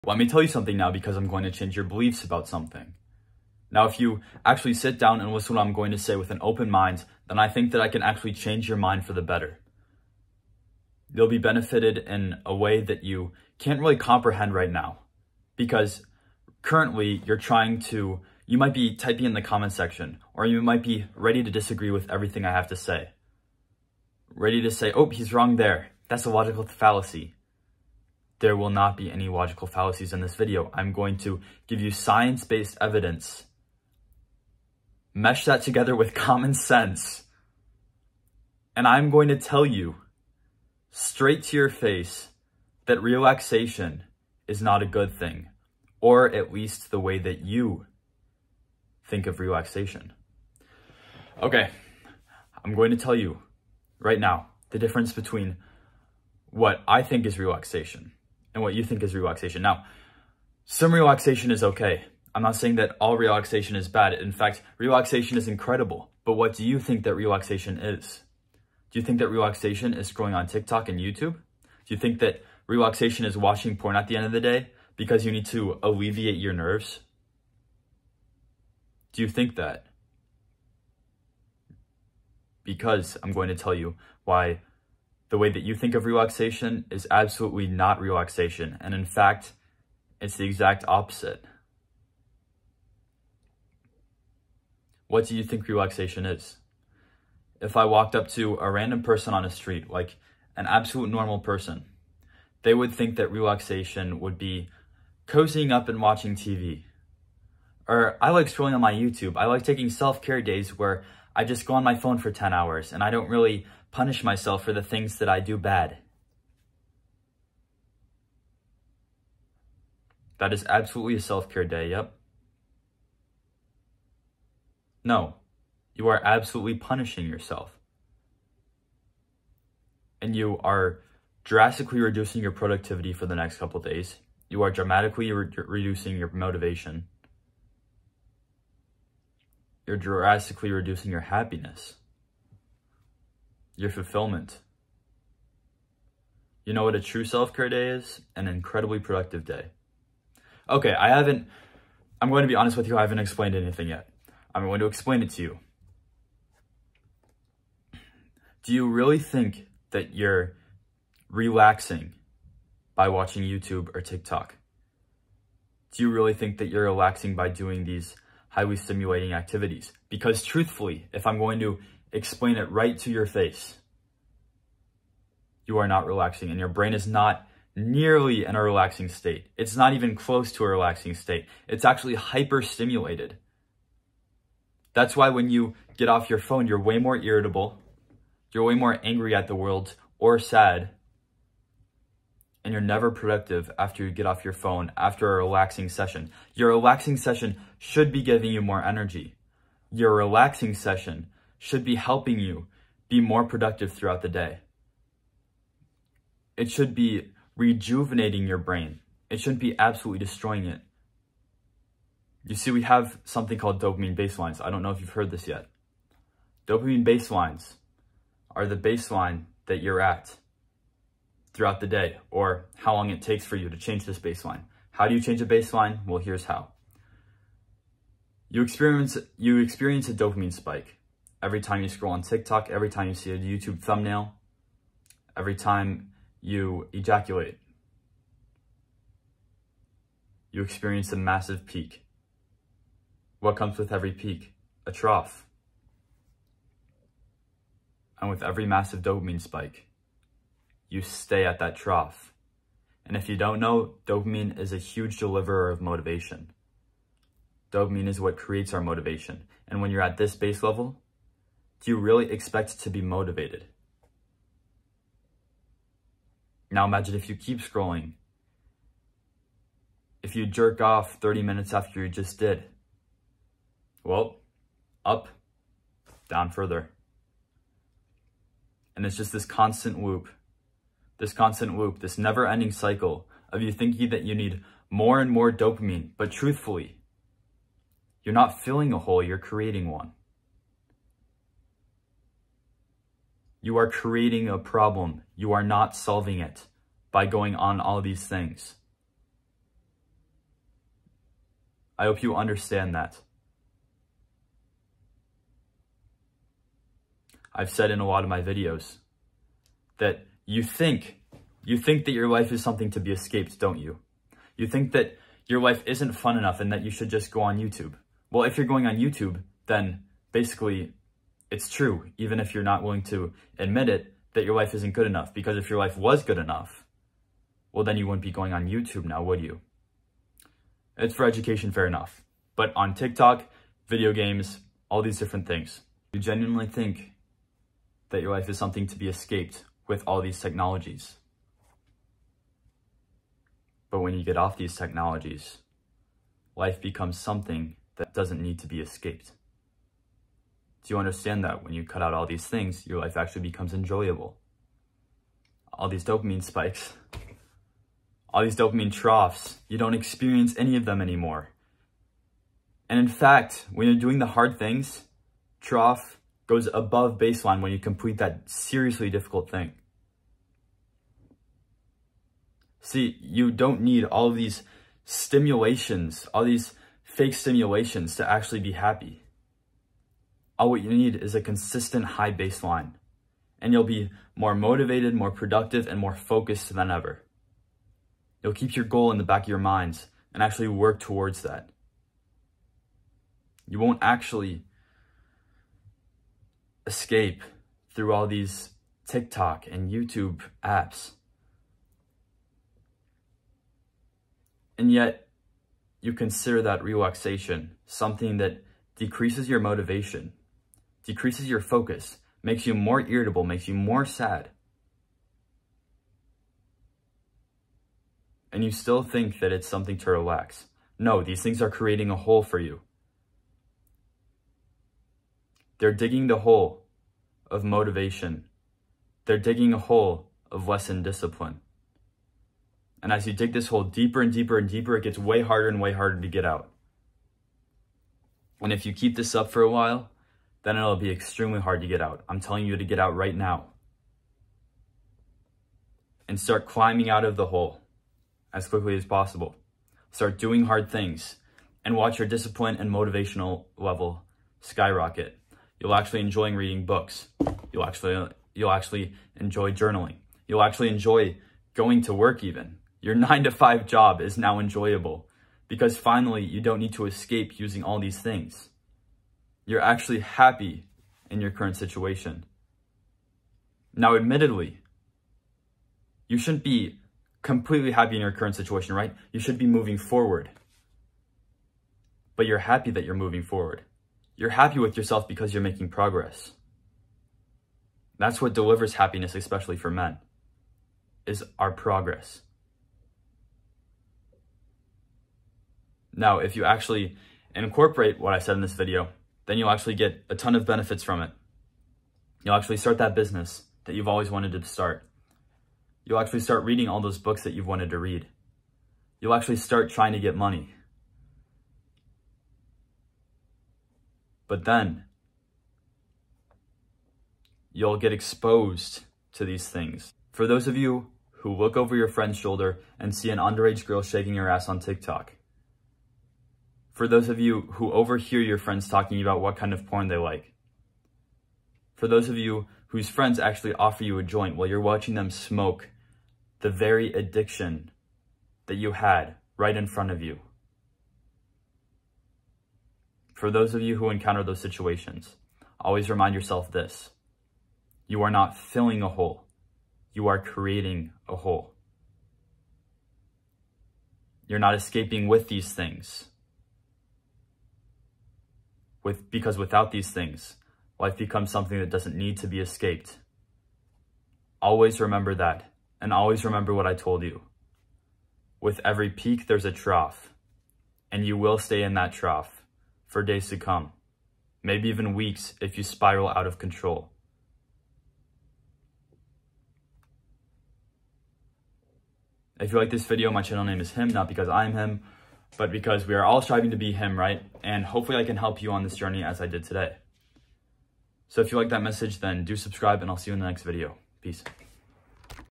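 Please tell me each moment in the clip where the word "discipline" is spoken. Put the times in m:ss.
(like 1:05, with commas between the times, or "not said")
7:11, 7:32.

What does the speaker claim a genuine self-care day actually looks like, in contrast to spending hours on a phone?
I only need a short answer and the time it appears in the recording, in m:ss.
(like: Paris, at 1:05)
An incredibly productive day, at 2:28.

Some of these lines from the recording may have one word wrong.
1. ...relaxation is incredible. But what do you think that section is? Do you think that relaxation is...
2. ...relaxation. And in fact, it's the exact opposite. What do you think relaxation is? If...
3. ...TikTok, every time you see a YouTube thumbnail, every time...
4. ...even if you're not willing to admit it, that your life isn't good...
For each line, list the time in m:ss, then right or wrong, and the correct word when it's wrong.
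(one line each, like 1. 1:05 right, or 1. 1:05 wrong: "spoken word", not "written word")
1. 1:04 wrong: "relaxation", not "section"
2. 1:28 right
3. 3:52 right
4. 5:22 right.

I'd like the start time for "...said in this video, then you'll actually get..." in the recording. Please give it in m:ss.
8:18.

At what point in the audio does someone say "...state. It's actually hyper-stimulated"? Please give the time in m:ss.
3:01.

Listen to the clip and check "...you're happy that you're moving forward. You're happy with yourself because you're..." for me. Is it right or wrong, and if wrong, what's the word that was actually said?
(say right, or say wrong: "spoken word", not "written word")
right.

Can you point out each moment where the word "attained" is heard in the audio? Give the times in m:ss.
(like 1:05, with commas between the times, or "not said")
not said.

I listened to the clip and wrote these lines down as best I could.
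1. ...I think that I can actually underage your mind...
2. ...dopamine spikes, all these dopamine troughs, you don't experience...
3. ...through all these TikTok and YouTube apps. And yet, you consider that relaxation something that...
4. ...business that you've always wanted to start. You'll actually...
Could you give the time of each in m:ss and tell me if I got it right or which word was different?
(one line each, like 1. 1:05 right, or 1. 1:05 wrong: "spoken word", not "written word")
1. 0:07 wrong: "change", not "underage"
2. 5:56 right
3. 6:37 right
4. 8:23 right.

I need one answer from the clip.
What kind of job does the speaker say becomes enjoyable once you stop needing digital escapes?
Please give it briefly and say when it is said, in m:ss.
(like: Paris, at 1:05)
9 to 5 job, at 7:43.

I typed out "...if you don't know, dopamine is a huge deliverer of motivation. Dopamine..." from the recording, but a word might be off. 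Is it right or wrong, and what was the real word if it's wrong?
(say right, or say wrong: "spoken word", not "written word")
right.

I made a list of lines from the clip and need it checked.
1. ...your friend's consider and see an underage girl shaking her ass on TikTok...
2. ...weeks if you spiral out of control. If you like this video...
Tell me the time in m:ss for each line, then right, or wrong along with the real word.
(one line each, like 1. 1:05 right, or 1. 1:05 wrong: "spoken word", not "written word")
1. 8:41 wrong: "shoulder", not "consider"
2. 9:35 right.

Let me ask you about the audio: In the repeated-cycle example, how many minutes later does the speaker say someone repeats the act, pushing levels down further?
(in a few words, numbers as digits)
30.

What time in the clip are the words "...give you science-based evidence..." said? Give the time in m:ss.
0:31.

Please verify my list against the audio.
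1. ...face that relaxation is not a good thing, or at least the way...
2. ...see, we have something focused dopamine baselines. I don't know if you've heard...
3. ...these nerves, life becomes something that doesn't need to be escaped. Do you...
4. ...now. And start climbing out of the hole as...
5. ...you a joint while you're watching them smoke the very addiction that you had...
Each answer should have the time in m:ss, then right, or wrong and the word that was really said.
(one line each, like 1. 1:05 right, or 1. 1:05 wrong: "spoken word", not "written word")
1. 0:41 right
2. 3:32 wrong: "called", not "focused"
3. 5:44 wrong: "technologies", not "nerves"
4. 7:23 right
5. 8:54 right.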